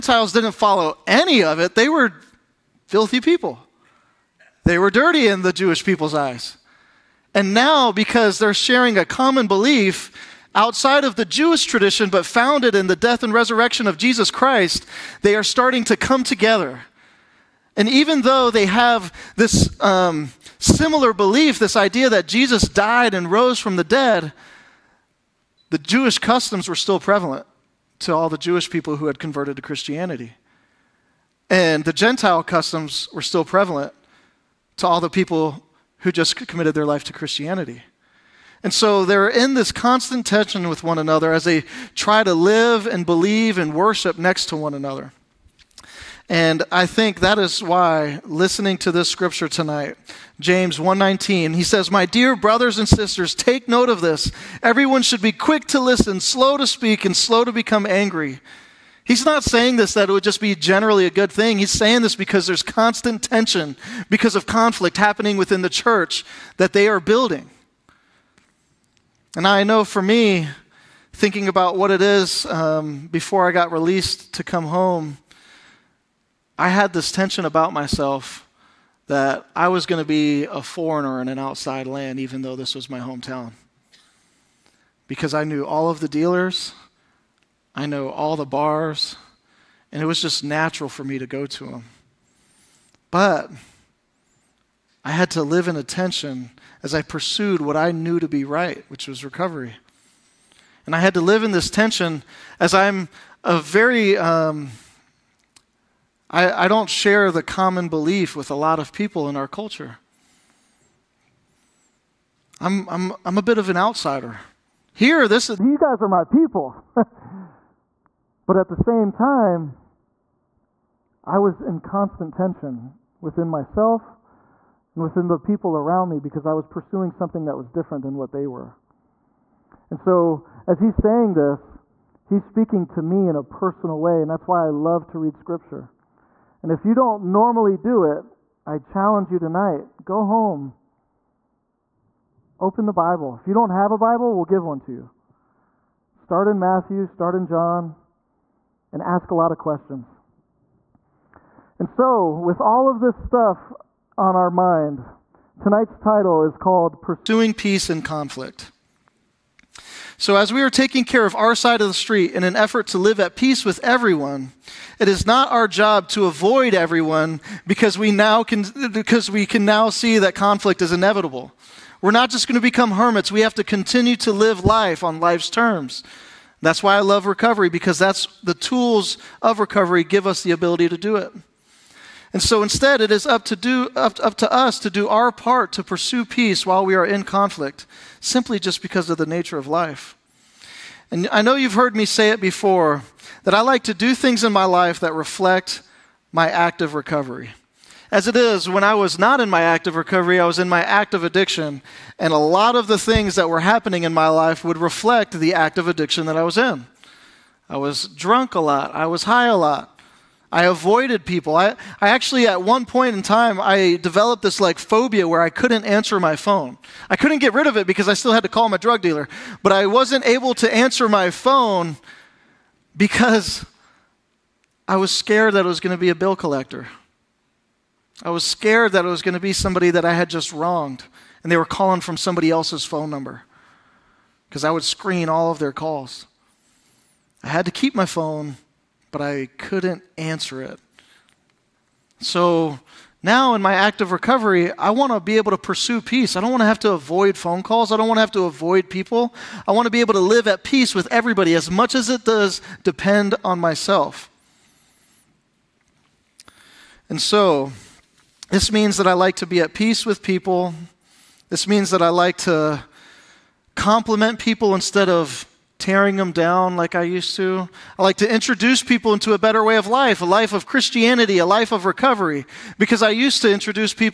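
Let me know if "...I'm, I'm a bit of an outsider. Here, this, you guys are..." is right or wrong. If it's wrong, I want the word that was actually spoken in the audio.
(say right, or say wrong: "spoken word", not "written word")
right.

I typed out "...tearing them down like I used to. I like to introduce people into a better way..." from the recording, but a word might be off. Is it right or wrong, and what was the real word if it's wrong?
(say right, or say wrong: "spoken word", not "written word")
right.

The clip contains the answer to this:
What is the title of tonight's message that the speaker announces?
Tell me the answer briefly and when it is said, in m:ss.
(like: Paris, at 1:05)
Pursuing Peace in Conflict, at 2:37.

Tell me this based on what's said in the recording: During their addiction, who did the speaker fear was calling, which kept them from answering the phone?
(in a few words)
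A bill collector.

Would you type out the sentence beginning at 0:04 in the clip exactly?
They were dirty in the Jewish people's eyes.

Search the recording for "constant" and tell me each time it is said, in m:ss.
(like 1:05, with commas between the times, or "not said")
0:39, 1:02, 2:01.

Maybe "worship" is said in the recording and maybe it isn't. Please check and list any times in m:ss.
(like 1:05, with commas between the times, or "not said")
0:43.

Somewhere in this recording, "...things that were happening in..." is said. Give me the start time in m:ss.
3:22.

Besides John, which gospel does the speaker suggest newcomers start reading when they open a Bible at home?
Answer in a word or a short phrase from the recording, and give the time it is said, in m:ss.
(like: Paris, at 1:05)
Matthew, at 2:26.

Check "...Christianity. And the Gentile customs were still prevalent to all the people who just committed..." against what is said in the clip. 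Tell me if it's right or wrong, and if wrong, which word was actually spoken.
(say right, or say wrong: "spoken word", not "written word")
right.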